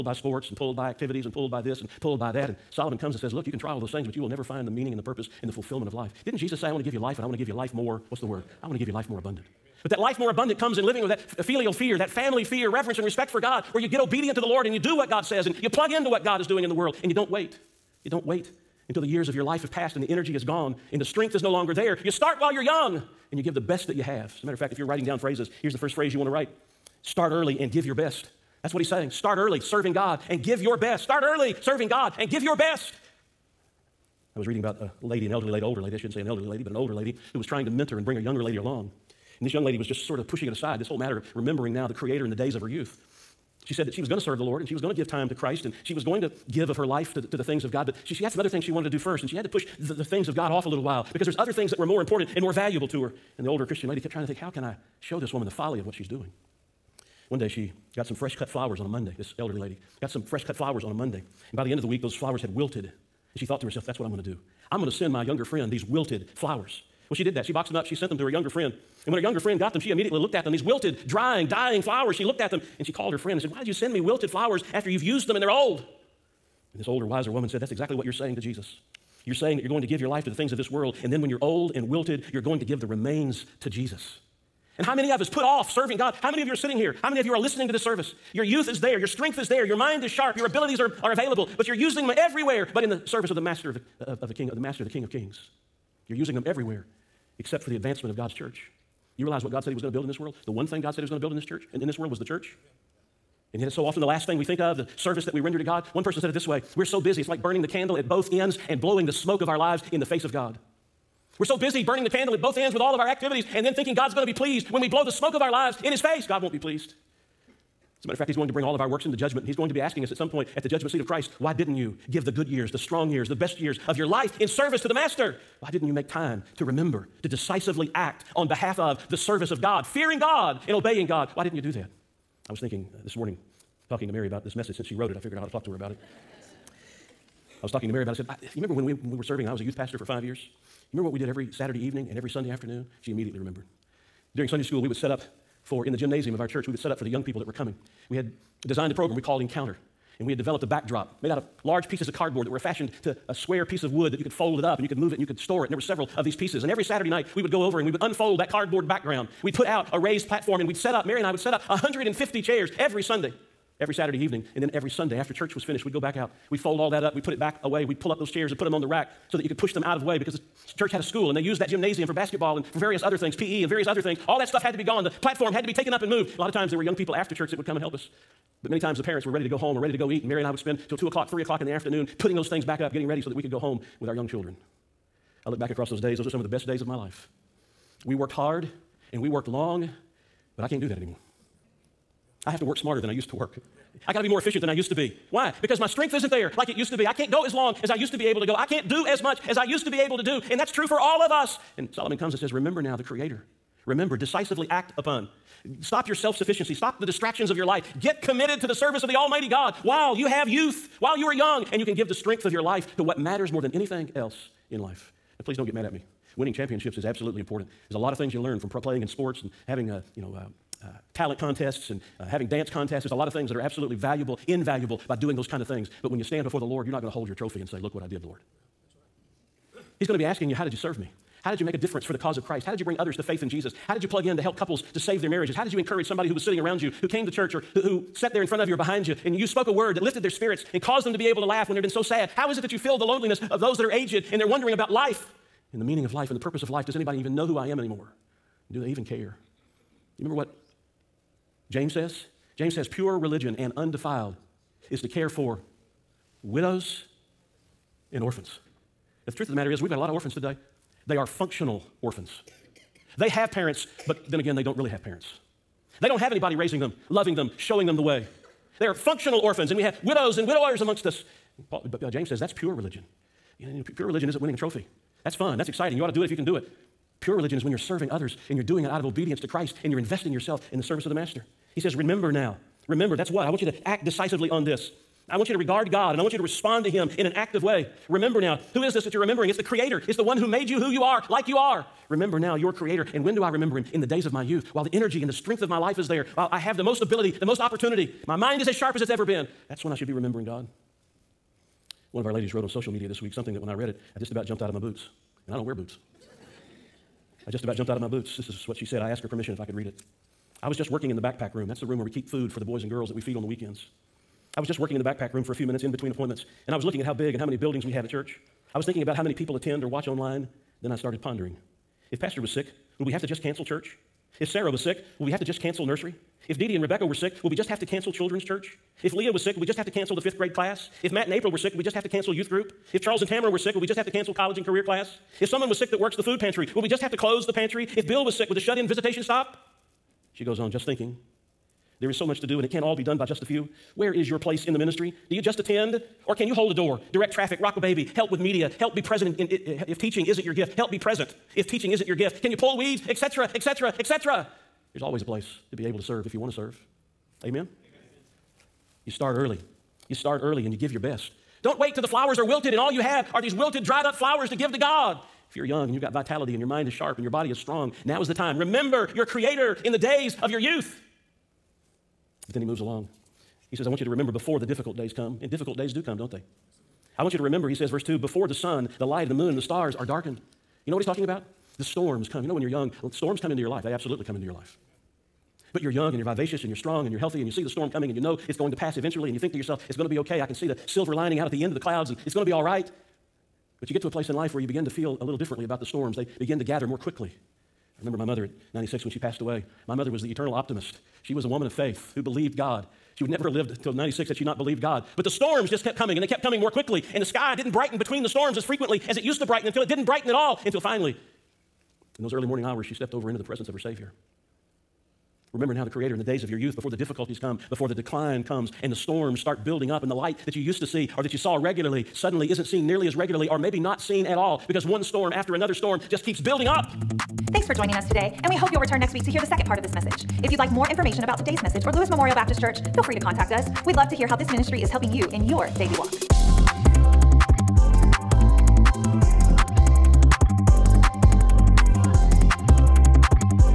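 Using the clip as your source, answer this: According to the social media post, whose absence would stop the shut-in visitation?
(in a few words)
Bill.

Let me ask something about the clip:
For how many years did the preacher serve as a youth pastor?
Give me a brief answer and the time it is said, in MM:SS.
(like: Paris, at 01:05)
5, at 02:20.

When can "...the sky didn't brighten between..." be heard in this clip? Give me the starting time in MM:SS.
06:47.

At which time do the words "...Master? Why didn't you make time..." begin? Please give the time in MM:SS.
02:04.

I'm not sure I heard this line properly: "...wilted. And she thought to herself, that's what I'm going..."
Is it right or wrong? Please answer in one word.
right.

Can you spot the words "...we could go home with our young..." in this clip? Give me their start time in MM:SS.
03:03.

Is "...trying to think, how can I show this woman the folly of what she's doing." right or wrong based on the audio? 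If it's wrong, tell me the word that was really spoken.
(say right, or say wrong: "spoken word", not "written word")
right.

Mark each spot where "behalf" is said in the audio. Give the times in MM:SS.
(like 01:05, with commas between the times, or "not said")
02:08.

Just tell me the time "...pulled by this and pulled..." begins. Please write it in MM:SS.
00:01.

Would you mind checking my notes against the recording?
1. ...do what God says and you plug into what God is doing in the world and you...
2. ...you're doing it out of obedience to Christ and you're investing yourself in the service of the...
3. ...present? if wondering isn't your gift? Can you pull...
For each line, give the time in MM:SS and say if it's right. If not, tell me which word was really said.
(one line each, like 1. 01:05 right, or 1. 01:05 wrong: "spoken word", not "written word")
1. 00:14 right
2. 04:38 right
3. 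05:50 wrong: "teaching", not "wondering".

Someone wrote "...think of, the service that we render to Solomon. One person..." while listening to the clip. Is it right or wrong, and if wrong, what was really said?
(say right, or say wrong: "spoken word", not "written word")
wrong: "God", not "Solomon".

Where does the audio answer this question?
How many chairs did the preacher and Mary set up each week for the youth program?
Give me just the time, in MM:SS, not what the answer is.
02:41.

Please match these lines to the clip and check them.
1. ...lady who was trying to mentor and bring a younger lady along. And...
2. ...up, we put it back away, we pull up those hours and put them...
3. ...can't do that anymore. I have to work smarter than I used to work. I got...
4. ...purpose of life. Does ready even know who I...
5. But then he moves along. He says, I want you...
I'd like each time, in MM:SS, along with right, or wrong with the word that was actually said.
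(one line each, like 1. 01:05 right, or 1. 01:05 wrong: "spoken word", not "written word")
1. 00:36 right
2. 02:47 wrong: "chairs", not "hours"
3. 03:10 right
4. 04:06 wrong: "anybody", not "ready"
5. 06:12 right.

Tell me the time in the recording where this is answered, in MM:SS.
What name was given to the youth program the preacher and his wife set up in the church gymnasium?
02:29.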